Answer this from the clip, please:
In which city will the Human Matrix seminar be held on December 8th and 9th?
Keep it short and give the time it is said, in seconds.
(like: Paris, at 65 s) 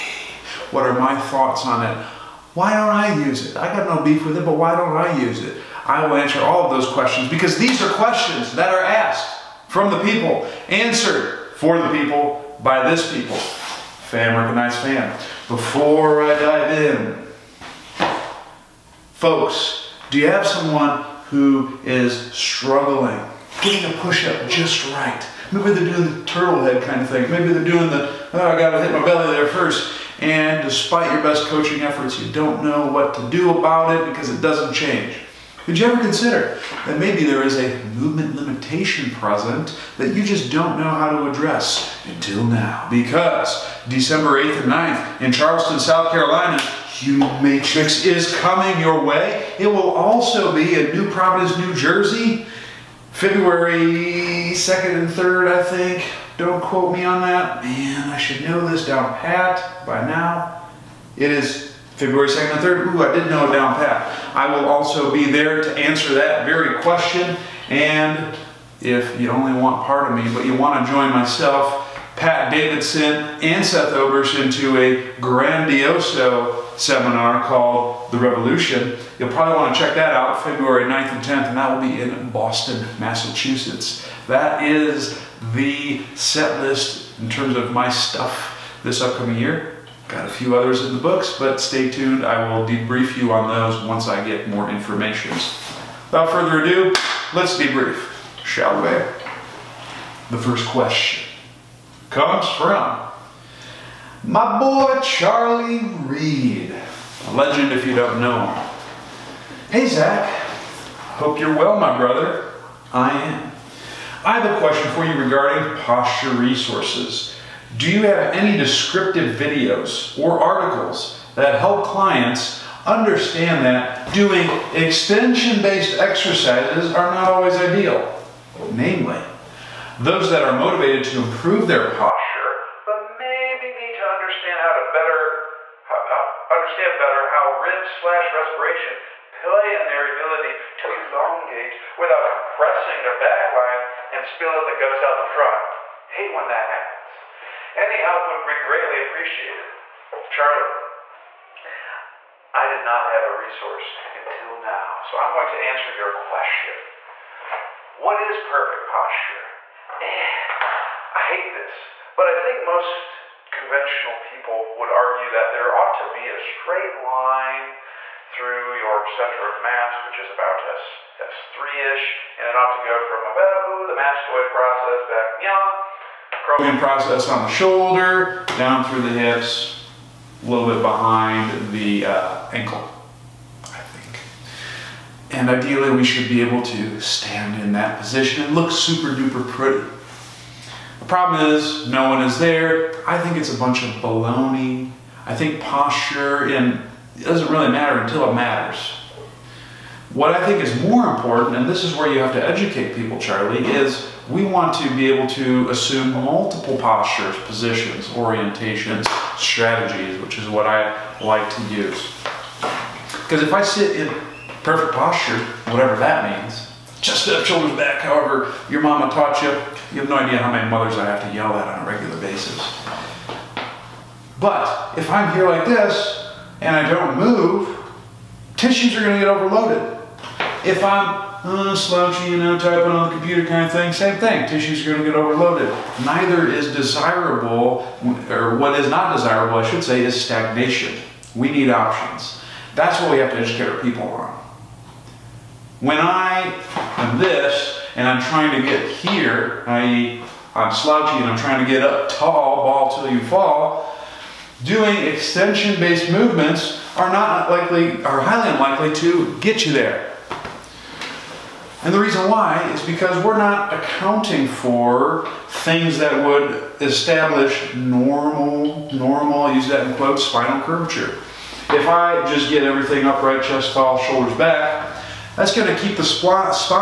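Charleston, South Carolina, at 45 s.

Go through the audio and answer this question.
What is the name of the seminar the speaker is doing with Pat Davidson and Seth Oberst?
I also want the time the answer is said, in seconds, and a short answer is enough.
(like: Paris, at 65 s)
the Revolution, at 78 s.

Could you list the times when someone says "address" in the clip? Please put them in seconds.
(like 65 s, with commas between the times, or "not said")
41 s.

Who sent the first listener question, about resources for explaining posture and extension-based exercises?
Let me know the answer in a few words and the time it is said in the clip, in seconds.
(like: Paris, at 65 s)
Charlie Reed, at 105 s.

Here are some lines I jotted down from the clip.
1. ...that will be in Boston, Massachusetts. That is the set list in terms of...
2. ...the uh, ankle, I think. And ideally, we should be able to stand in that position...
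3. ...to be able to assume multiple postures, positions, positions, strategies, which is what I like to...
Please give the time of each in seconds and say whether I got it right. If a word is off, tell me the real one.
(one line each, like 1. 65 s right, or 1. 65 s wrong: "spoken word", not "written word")
1. 81 s right
2. 181 s right
3. 204 s wrong: "orientations", not "positions".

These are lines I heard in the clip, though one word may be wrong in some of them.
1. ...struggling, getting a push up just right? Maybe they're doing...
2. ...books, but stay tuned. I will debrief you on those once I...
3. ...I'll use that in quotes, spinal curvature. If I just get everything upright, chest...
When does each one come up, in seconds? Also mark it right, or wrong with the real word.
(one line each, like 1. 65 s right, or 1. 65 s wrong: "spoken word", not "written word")
1. 22 s right
2. 90 s right
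3. 269 s right.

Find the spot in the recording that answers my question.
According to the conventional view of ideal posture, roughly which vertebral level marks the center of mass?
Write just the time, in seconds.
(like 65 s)
171 s.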